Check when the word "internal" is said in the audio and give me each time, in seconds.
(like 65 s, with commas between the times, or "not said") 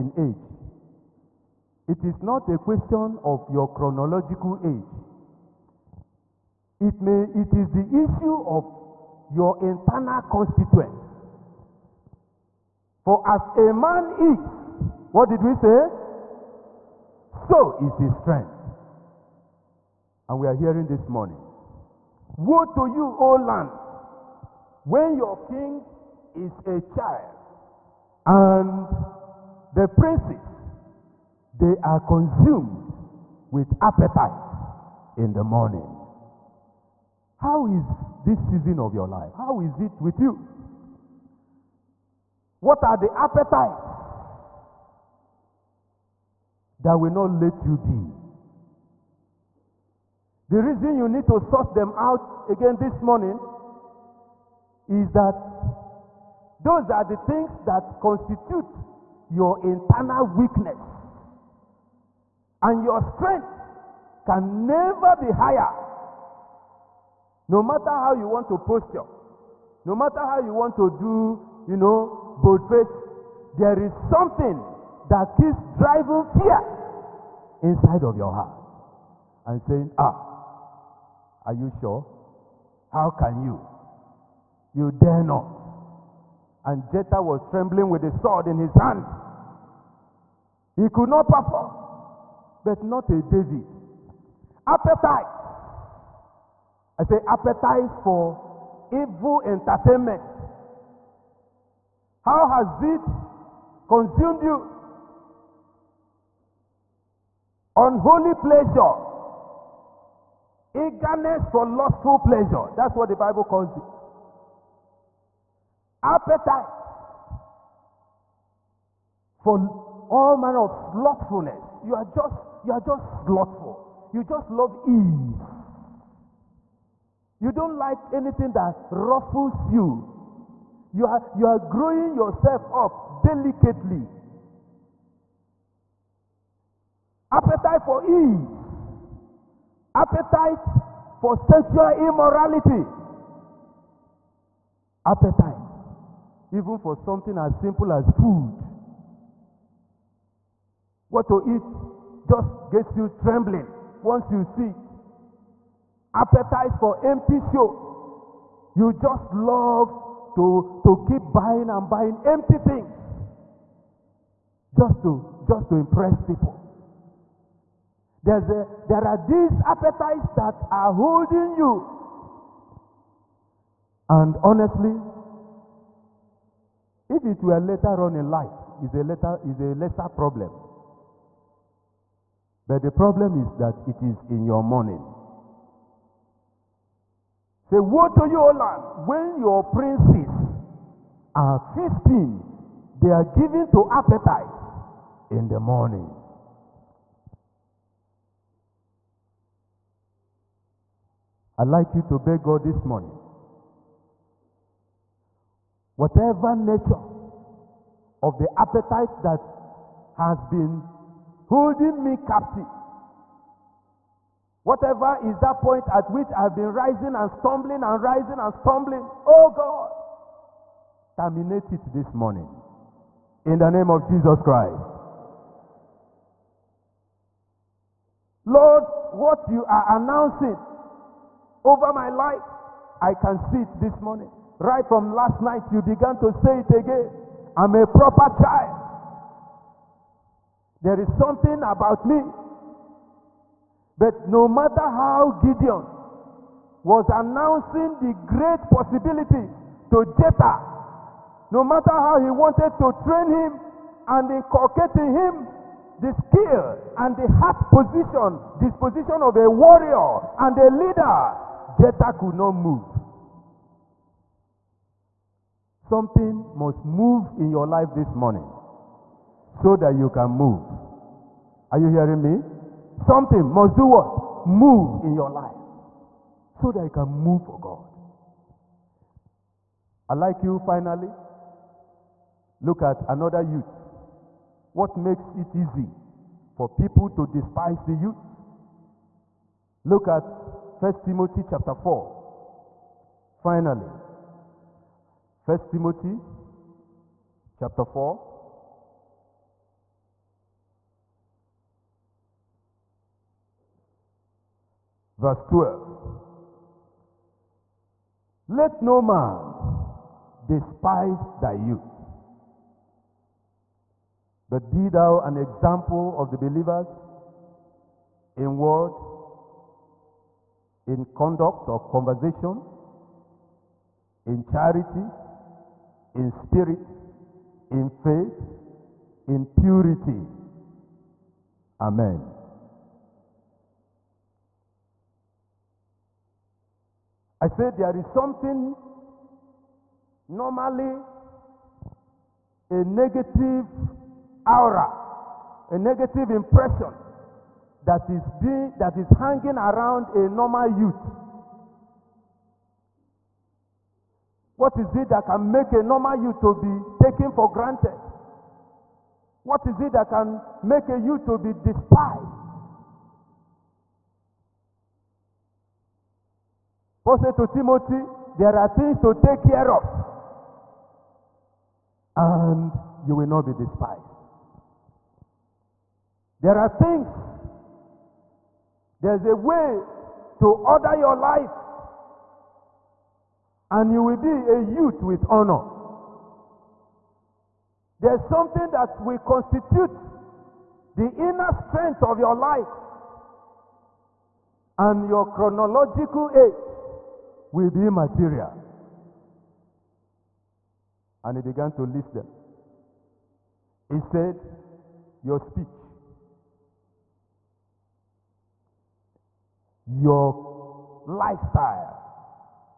9 s, 59 s.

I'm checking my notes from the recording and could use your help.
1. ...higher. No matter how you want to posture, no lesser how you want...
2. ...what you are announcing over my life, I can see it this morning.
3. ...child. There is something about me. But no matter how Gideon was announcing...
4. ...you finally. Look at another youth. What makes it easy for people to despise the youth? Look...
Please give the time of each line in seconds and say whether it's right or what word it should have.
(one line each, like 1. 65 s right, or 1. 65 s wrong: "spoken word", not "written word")
1. 65 s wrong: "matter", not "lesser"
2. 229 s right
3. 238 s right
4. 280 s right.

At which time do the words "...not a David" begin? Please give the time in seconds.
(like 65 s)
92 s.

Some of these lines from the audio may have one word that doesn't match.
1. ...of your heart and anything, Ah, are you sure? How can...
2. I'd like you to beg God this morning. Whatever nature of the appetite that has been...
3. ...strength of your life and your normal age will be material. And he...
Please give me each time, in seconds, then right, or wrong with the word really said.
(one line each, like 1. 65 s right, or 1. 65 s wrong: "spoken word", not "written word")
1. 78 s wrong: "saying", not "anything"
2. 201 s right
3. 391 s wrong: "chronological", not "normal".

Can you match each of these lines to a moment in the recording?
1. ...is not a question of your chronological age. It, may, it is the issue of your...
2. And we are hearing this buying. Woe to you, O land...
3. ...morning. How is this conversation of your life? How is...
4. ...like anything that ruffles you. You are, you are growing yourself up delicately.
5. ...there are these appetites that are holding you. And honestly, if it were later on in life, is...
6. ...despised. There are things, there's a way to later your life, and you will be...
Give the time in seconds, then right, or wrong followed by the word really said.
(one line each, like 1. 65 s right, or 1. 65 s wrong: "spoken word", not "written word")
1. 2 s right
2. 20 s wrong: "morning", not "buying"
3. 35 s wrong: "season", not "conversation"
4. 127 s right
5. 168 s right
6. 373 s wrong: "order", not "later".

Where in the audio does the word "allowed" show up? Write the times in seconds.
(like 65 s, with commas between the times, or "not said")
not said.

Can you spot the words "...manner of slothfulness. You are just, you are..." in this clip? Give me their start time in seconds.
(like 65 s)
120 s.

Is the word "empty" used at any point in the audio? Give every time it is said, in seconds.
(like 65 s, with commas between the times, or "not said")
157 s, 162 s.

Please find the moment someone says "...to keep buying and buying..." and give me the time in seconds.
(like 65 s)
160 s.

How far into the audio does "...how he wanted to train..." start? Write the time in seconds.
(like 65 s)
251 s.